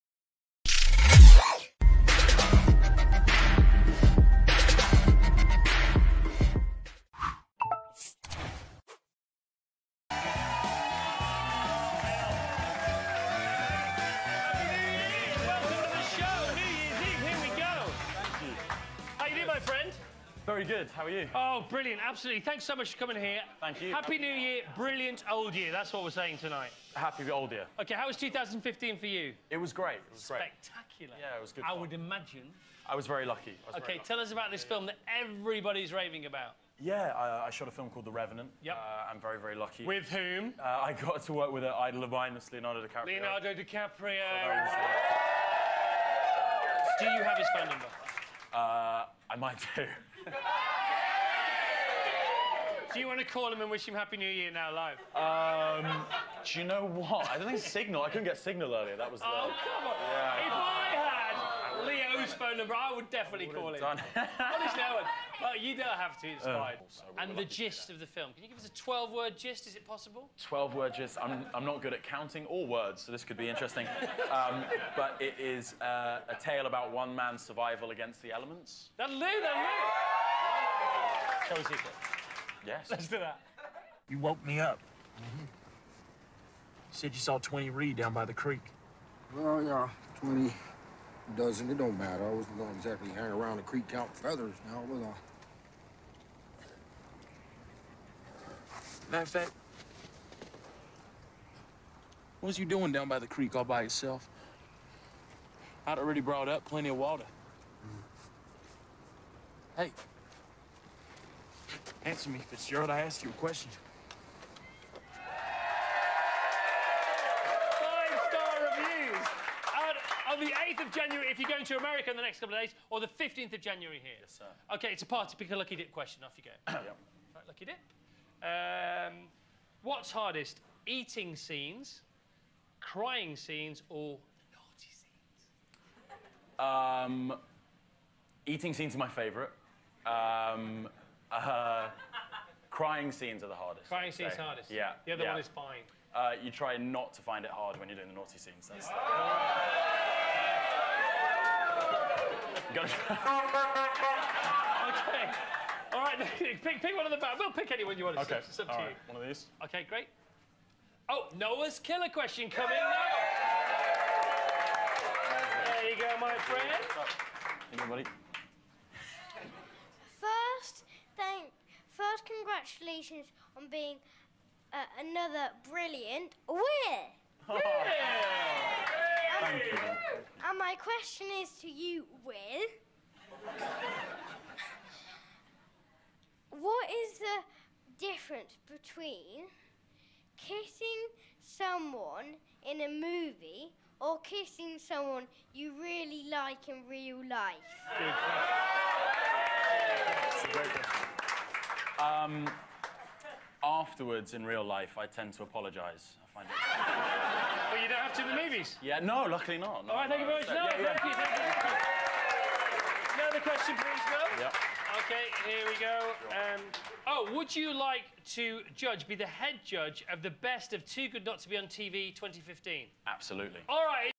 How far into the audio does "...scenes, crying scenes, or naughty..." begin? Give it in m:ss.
2:11.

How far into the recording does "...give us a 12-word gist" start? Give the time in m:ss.
1:08.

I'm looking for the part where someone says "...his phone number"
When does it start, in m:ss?
0:47.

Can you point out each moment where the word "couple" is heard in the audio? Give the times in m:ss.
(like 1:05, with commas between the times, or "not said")
2:02.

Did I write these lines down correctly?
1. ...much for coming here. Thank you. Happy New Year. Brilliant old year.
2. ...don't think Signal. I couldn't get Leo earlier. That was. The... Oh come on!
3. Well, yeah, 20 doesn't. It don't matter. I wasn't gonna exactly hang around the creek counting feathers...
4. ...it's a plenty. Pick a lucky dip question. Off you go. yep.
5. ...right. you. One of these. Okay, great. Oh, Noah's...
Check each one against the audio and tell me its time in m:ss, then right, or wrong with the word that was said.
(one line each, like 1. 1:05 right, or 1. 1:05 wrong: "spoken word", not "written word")
1. 0:22 right
2. 0:57 wrong: "Signal", not "Leo"
3. 1:29 right
4. 2:04 wrong: "party", not "plenty"
5. 2:38 right.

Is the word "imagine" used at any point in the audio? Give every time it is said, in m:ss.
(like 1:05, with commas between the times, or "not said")
0:31.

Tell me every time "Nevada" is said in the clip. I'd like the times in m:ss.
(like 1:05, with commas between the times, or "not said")
not said.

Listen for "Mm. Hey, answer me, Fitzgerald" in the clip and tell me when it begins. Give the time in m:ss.
1:49.